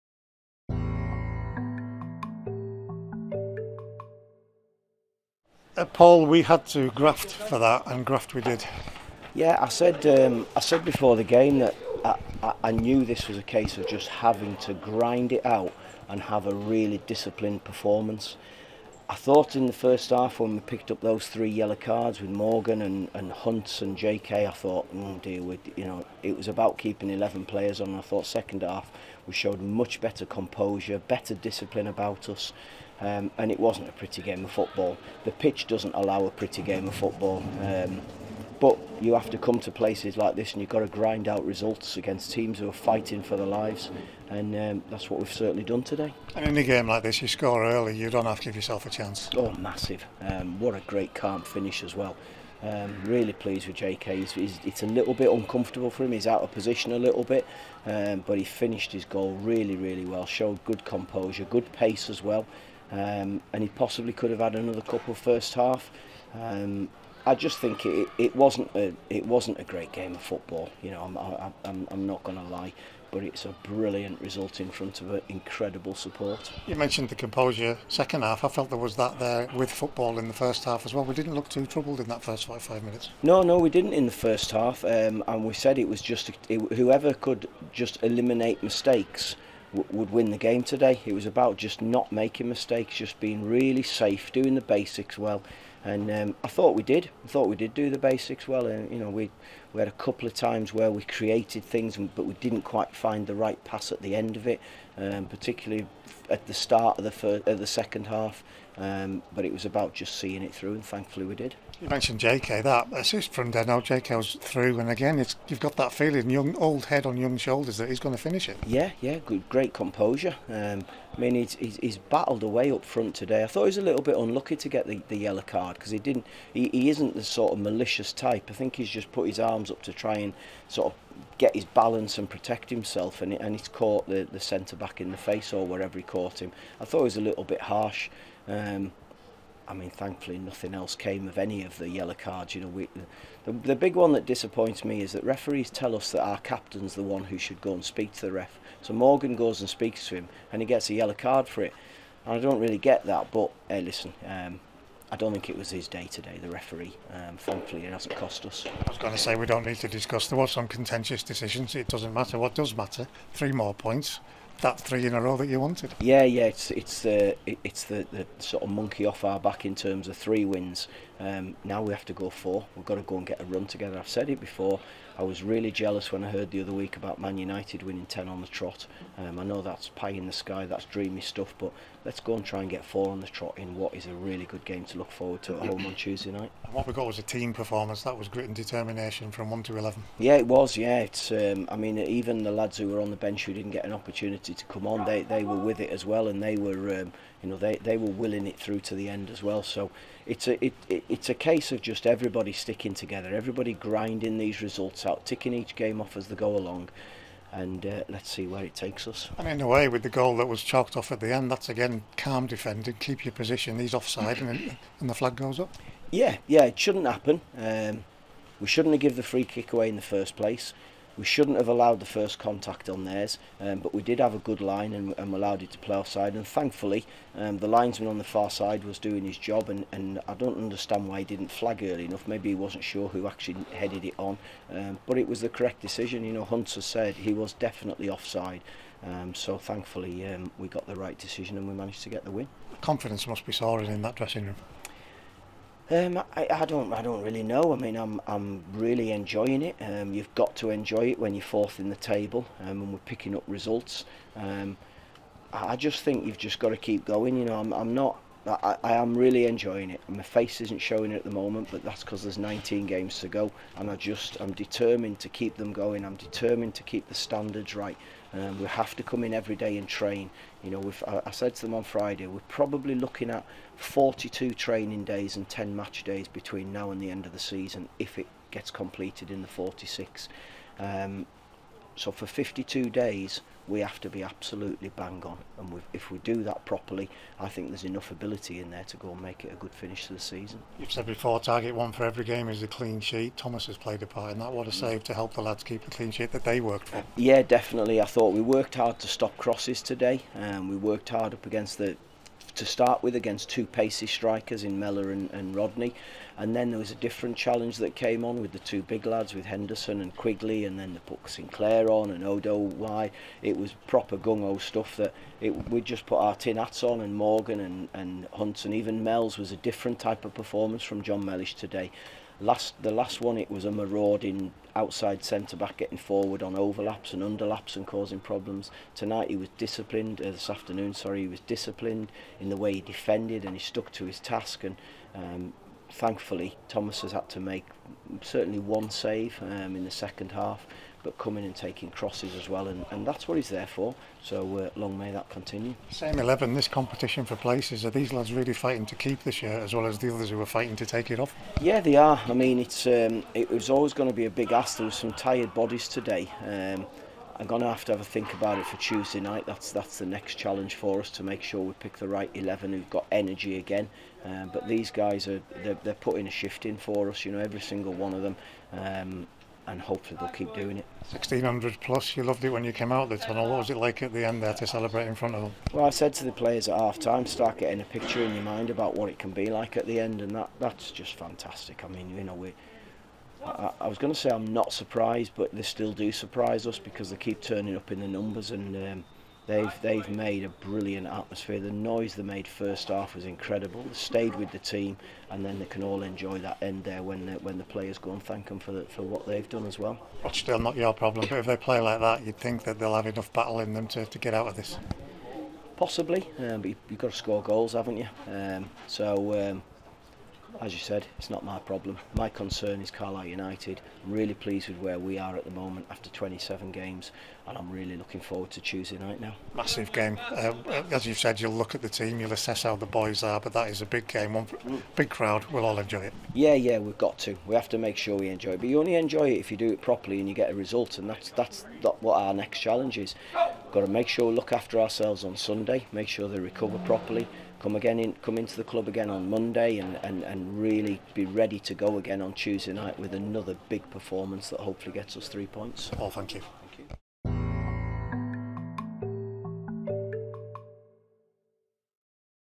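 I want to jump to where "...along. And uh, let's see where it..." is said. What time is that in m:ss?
3:26.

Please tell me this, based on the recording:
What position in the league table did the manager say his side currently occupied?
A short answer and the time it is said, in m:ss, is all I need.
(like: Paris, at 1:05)
Fourth, at 4:11.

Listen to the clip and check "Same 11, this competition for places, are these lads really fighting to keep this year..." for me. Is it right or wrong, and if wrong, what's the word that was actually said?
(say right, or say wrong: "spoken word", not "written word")
right.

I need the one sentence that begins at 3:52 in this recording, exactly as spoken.
Maybe he wasn't sure who actually headed it on, um, but it was the correct decision.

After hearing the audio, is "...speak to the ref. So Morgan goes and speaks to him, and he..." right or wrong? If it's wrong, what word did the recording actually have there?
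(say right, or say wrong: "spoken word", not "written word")
right.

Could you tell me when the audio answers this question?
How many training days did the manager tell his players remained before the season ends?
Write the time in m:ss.
4:33.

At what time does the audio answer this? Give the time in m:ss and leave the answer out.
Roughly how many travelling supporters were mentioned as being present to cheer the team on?
6:11.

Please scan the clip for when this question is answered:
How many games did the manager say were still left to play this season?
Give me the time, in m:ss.
4:22.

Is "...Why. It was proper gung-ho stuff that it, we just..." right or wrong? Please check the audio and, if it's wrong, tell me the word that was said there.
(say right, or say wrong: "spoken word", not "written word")
right.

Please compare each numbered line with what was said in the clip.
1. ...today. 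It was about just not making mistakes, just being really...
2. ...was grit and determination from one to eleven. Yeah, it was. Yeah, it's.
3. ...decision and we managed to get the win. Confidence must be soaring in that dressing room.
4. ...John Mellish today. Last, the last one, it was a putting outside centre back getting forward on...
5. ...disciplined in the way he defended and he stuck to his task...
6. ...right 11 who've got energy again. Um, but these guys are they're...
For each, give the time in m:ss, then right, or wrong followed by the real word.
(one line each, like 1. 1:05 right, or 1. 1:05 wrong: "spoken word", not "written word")
1. 1:30 right
2. 3:08 right
3. 4:01 right
4. 5:21 wrong: "marauding", not "putting"
5. 5:31 right
6. 6:02 right.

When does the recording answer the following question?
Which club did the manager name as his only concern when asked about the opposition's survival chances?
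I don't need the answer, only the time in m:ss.
6:52.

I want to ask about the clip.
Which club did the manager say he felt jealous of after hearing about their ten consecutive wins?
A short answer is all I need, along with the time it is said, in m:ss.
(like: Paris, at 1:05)
Man United, at 2:57.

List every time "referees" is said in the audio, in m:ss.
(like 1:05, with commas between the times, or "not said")
2:25, 2:36.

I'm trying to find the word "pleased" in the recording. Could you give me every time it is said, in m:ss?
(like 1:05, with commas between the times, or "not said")
0:53, 6:54.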